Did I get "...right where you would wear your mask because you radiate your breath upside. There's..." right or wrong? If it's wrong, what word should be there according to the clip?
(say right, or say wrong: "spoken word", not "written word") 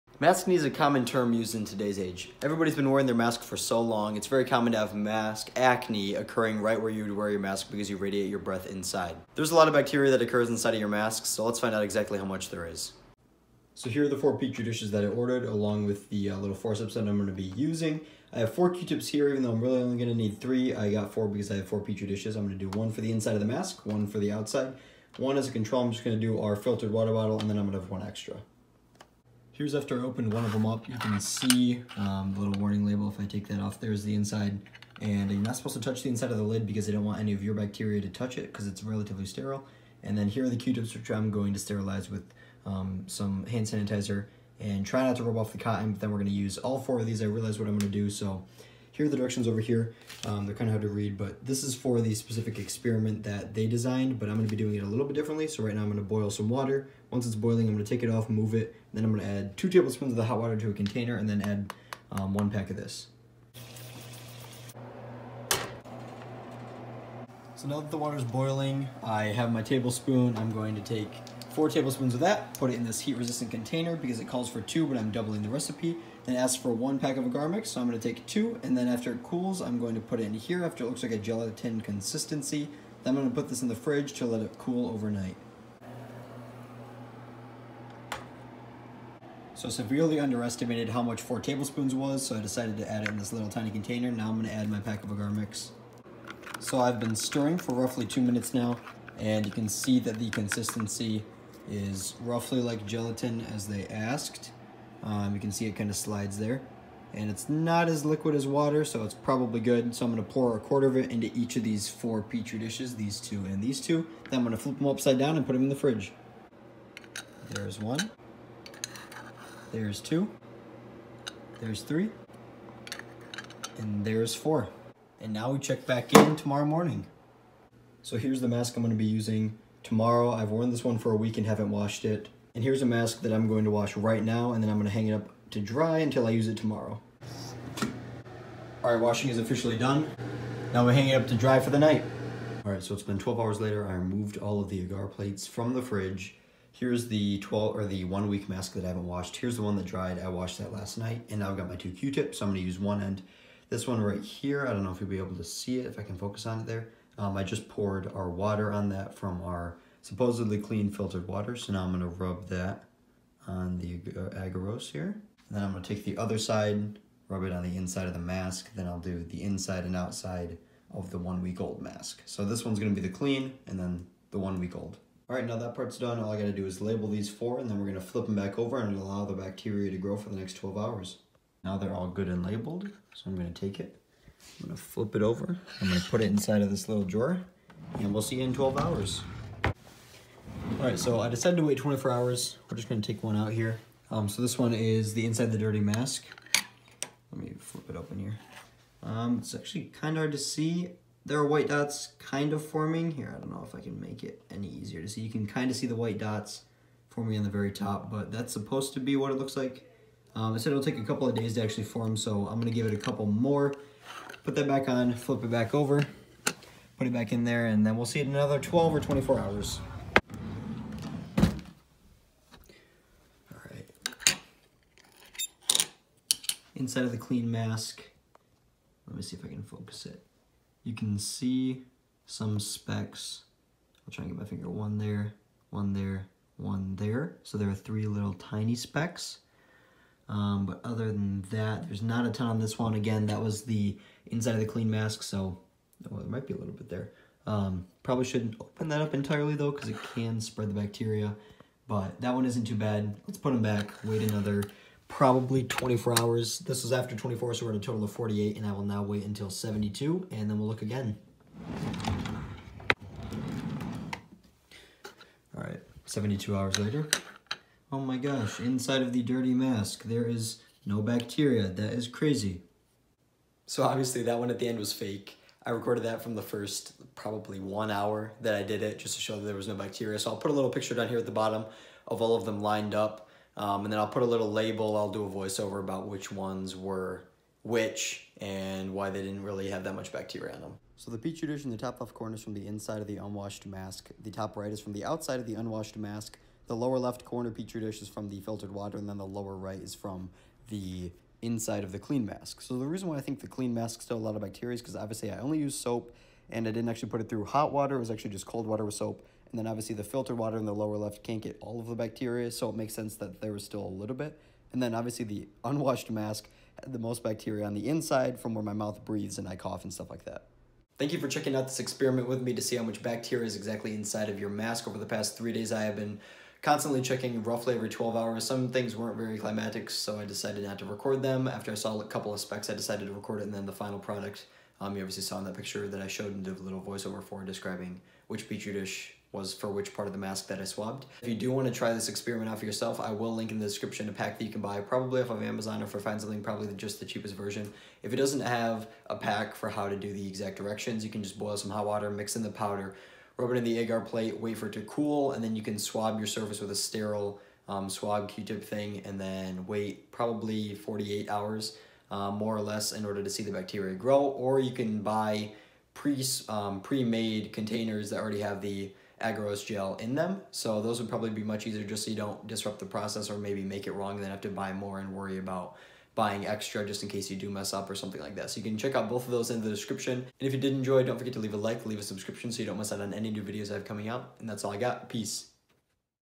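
wrong: "inside", not "upside".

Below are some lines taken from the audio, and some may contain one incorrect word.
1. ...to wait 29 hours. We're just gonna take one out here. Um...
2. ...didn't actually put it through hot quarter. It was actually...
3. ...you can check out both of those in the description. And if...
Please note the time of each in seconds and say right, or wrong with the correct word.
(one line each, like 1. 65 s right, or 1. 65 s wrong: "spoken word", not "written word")
1. 191 s wrong: "24", not "29"
2. 306 s wrong: "water", not "quarter"
3. 378 s right.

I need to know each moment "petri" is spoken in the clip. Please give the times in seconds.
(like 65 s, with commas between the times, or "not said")
14 s, 21 s, 112 s, 291 s, 297 s, 338 s.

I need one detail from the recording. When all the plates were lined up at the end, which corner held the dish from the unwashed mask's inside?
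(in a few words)
Top left.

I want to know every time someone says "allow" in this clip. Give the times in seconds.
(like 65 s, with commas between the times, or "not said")
178 s.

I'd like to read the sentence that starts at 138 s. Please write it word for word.
All right, washing is officially done.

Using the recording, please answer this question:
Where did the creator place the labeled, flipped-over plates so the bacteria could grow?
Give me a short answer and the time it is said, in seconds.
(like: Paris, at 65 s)
Little drawer, at 186 s.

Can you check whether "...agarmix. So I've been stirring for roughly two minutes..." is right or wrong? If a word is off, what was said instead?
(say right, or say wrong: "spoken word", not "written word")
right.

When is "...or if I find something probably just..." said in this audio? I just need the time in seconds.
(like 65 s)
345 s.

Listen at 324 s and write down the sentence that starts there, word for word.
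Over the past three days I have been constantly checking roughly every 12 hours.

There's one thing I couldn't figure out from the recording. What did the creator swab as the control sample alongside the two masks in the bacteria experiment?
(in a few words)
Filtered water bottle.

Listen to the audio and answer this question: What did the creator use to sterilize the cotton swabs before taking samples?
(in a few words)
Hand sanitizer.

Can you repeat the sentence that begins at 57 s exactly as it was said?
Once it's boiling, I'm going to take it off, move it.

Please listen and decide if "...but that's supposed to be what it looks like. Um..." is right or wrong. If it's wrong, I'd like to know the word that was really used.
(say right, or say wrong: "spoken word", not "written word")
right.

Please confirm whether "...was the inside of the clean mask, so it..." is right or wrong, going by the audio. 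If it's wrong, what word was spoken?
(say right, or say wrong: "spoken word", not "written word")
right.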